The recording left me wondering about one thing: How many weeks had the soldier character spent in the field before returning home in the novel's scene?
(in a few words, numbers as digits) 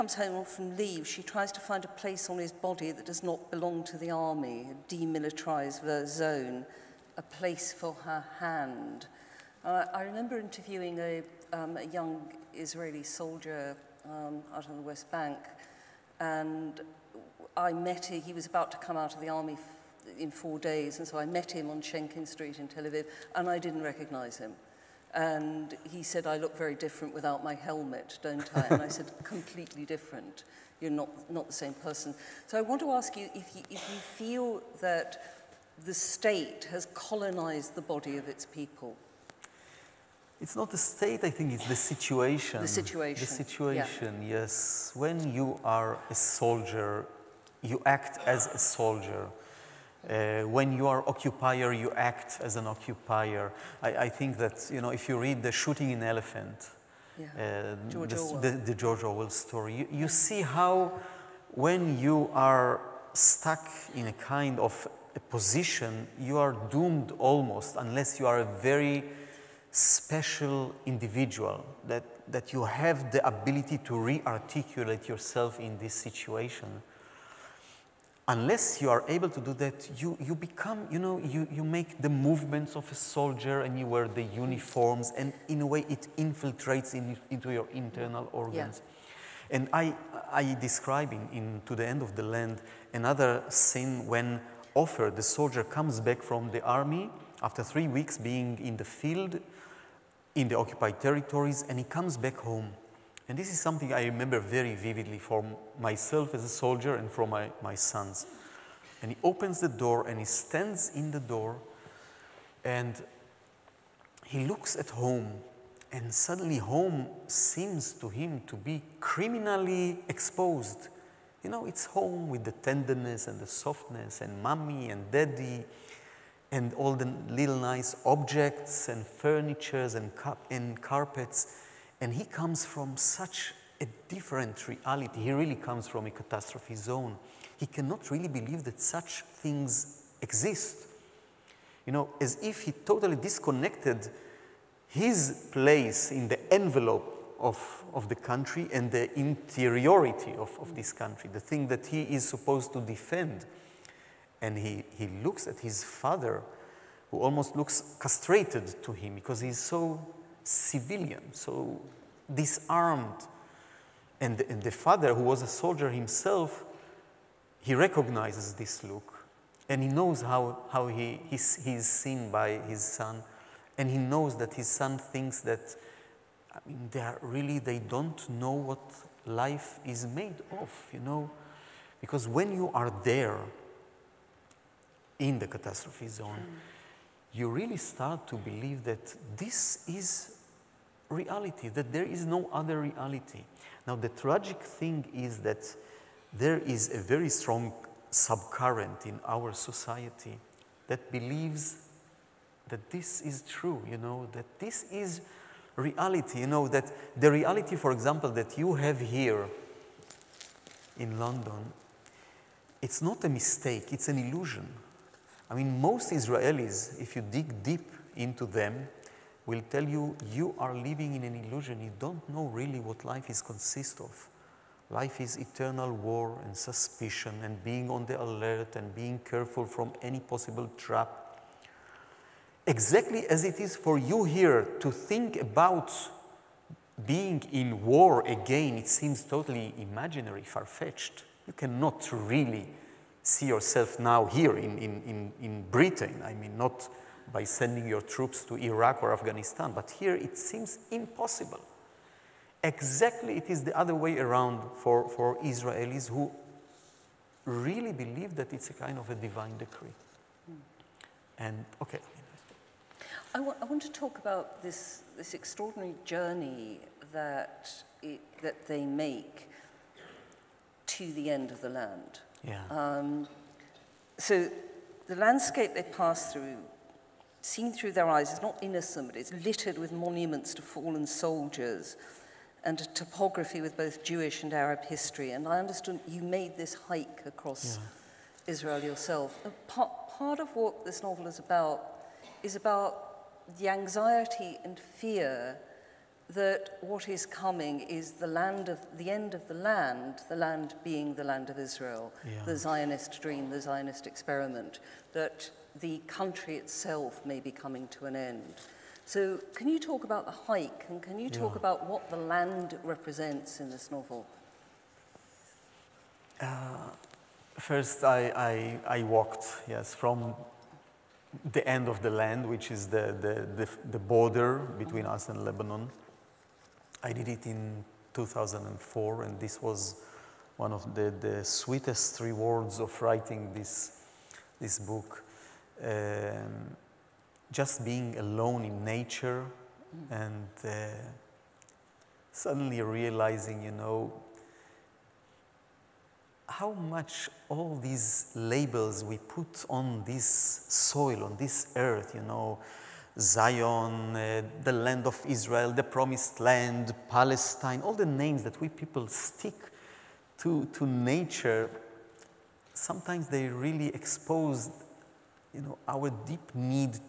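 3.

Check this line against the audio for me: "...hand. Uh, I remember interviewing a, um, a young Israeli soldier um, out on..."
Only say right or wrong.
right.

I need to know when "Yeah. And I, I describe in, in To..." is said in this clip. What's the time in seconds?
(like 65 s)
88 s.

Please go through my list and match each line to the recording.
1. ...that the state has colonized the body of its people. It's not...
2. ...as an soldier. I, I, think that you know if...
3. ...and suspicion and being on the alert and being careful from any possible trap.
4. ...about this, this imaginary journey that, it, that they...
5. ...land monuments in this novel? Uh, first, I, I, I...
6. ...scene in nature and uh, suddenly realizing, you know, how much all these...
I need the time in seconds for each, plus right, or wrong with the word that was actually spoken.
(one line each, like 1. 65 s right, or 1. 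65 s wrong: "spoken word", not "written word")
1. 34 s right
2. 52 s wrong: "occupier", not "soldier"
3. 226 s right
4. 264 s wrong: "extraordinary", not "imaginary"
5. 312 s wrong: "represents", not "monuments"
6. 338 s wrong: "alone", not "scene".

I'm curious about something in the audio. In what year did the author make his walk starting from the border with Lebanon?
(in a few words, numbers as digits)
2004.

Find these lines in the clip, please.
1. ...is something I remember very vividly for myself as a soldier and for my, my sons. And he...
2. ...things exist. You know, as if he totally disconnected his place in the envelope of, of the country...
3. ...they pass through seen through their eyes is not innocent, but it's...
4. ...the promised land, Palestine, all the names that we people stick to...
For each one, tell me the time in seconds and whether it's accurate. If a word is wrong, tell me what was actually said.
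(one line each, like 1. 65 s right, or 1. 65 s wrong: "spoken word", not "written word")
1. 103 s right
2. 139 s right
3. 275 s right
4. 355 s right.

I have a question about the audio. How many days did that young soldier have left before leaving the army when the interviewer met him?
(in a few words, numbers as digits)
4.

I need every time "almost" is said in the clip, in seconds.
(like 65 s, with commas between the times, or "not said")
67 s, 157 s.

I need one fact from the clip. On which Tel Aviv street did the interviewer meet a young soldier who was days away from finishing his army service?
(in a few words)
Shenkin Street.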